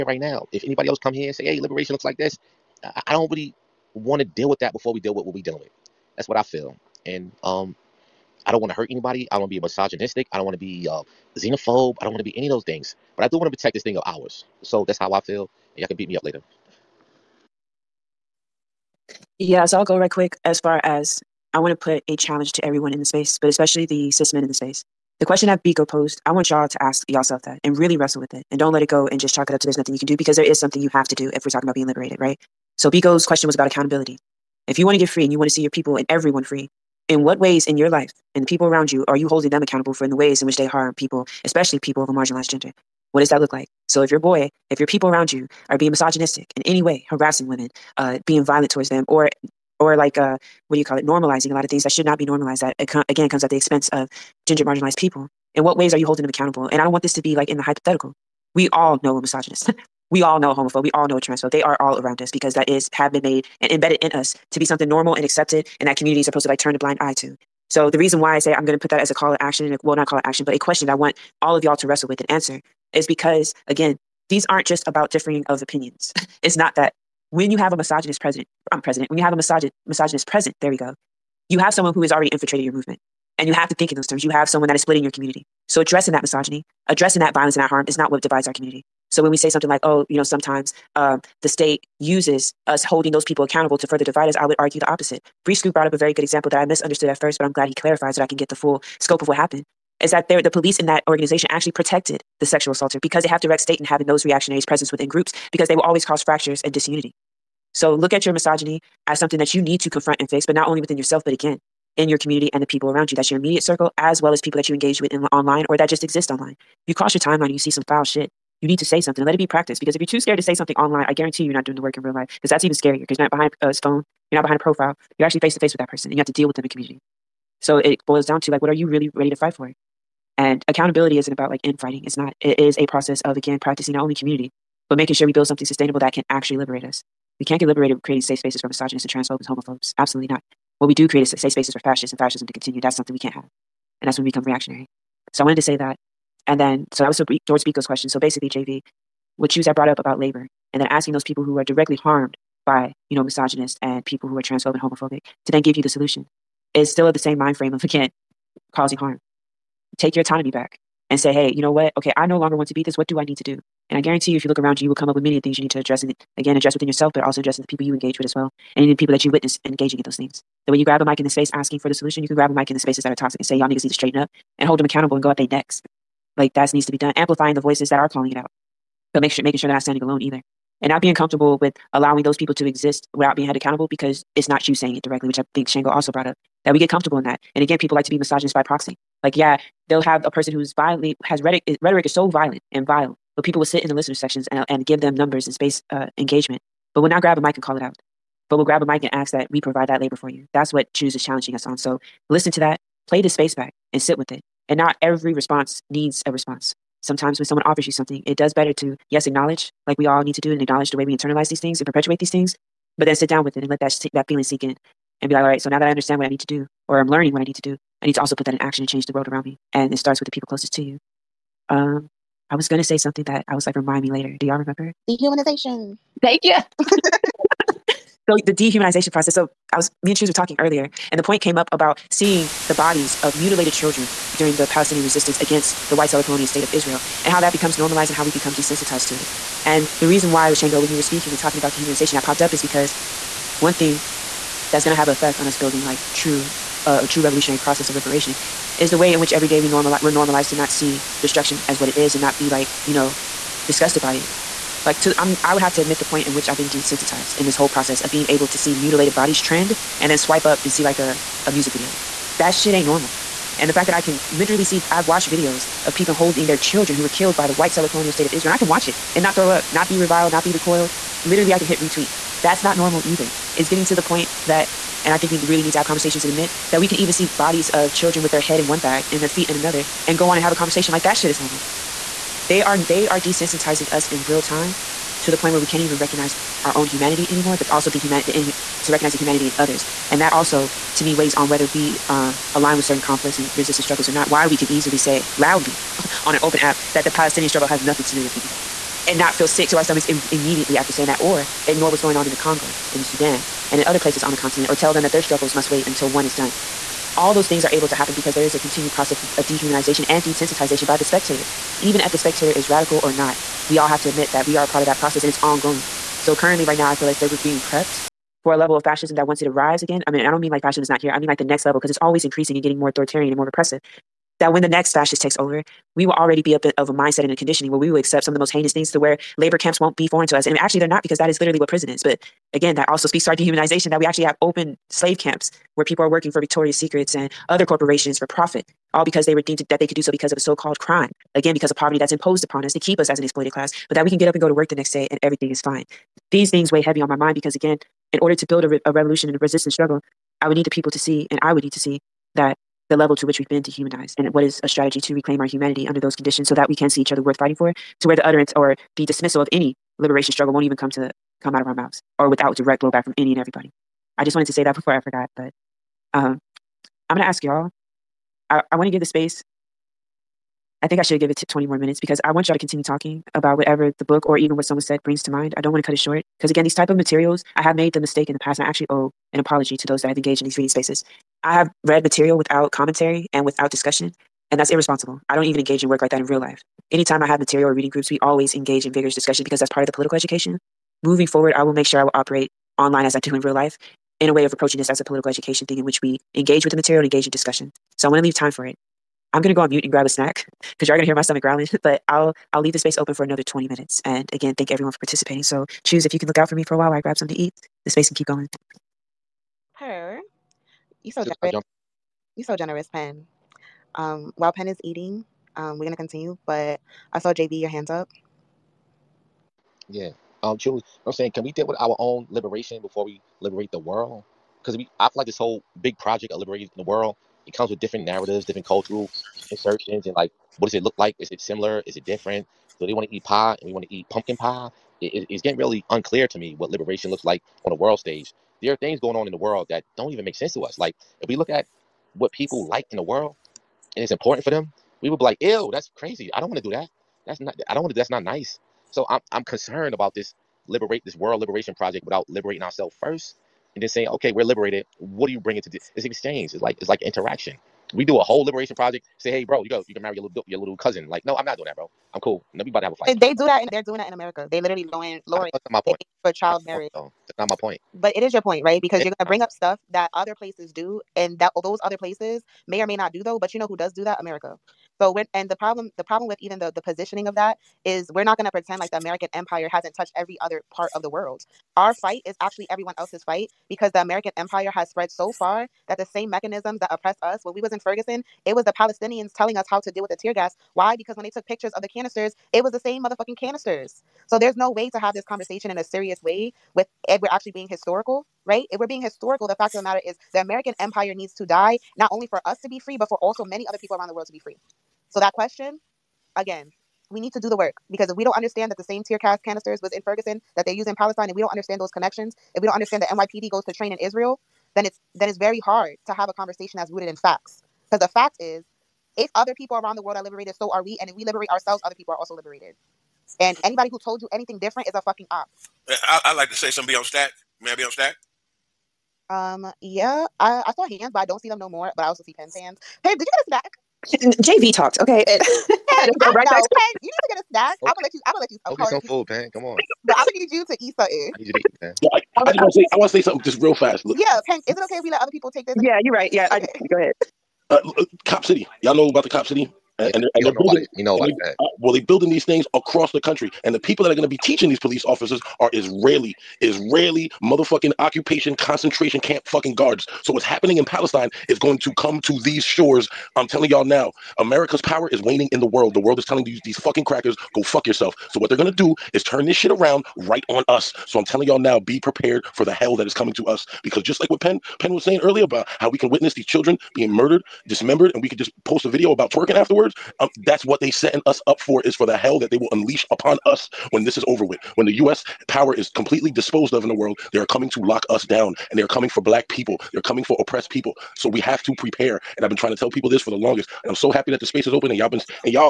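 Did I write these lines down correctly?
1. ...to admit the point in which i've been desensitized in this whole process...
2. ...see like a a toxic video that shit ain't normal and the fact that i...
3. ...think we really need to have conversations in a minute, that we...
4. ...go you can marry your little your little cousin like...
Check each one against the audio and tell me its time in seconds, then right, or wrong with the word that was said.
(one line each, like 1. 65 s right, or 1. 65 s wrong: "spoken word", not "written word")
1. 255 s right
2. 260 s wrong: "music", not "toxic"
3. 275 s right
4. 459 s right.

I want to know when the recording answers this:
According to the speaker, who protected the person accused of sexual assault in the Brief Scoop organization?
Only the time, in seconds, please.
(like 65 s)
100 s.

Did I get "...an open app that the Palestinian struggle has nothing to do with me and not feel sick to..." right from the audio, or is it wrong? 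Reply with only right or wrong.
right.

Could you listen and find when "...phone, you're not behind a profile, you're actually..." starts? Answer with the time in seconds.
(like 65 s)
123 s.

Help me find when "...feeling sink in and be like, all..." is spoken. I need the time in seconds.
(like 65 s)
214 s.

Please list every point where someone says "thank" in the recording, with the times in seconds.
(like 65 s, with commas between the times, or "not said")
226 s, 404 s.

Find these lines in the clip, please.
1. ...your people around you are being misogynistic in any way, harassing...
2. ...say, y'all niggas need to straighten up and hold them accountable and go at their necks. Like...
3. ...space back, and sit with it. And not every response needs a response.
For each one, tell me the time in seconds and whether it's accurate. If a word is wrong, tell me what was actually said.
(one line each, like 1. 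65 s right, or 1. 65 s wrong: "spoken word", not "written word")
1. 44 s right
2. 173 s right
3. 203 s right.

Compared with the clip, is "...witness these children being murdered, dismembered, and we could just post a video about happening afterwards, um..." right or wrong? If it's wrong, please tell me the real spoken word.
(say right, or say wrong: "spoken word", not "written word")
wrong: "twerking", not "happening".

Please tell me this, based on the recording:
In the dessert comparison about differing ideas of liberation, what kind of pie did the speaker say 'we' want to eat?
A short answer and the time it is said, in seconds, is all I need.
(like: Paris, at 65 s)
Pumpkin pie, at 434 s.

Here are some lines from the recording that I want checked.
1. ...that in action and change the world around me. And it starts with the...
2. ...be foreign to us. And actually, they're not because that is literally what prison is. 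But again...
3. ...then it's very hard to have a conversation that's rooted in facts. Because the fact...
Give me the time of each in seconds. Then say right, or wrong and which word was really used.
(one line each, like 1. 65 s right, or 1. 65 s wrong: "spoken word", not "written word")
1. 218 s right
2. 329 s right
3. 515 s right.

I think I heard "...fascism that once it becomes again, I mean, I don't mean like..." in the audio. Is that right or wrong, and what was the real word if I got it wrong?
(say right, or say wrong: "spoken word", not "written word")
wrong: "arrives", not "becomes".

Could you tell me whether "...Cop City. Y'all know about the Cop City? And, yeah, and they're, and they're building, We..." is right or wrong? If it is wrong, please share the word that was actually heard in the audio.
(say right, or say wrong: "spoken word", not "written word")
right.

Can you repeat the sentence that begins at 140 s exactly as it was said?
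What we do create is safe spaces for fascists and fascism to continue.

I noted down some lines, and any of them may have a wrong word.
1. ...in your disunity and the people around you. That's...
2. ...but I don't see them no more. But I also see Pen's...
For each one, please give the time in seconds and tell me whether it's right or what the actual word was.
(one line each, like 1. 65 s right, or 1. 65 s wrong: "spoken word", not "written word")
1. 111 s wrong: "community", not "disunity"
2. 531 s right.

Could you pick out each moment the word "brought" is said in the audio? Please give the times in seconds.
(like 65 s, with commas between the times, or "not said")
95 s, 149 s, 186 s.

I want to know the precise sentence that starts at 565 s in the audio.
The world is telling these these fucking crackers, go fuck yourself.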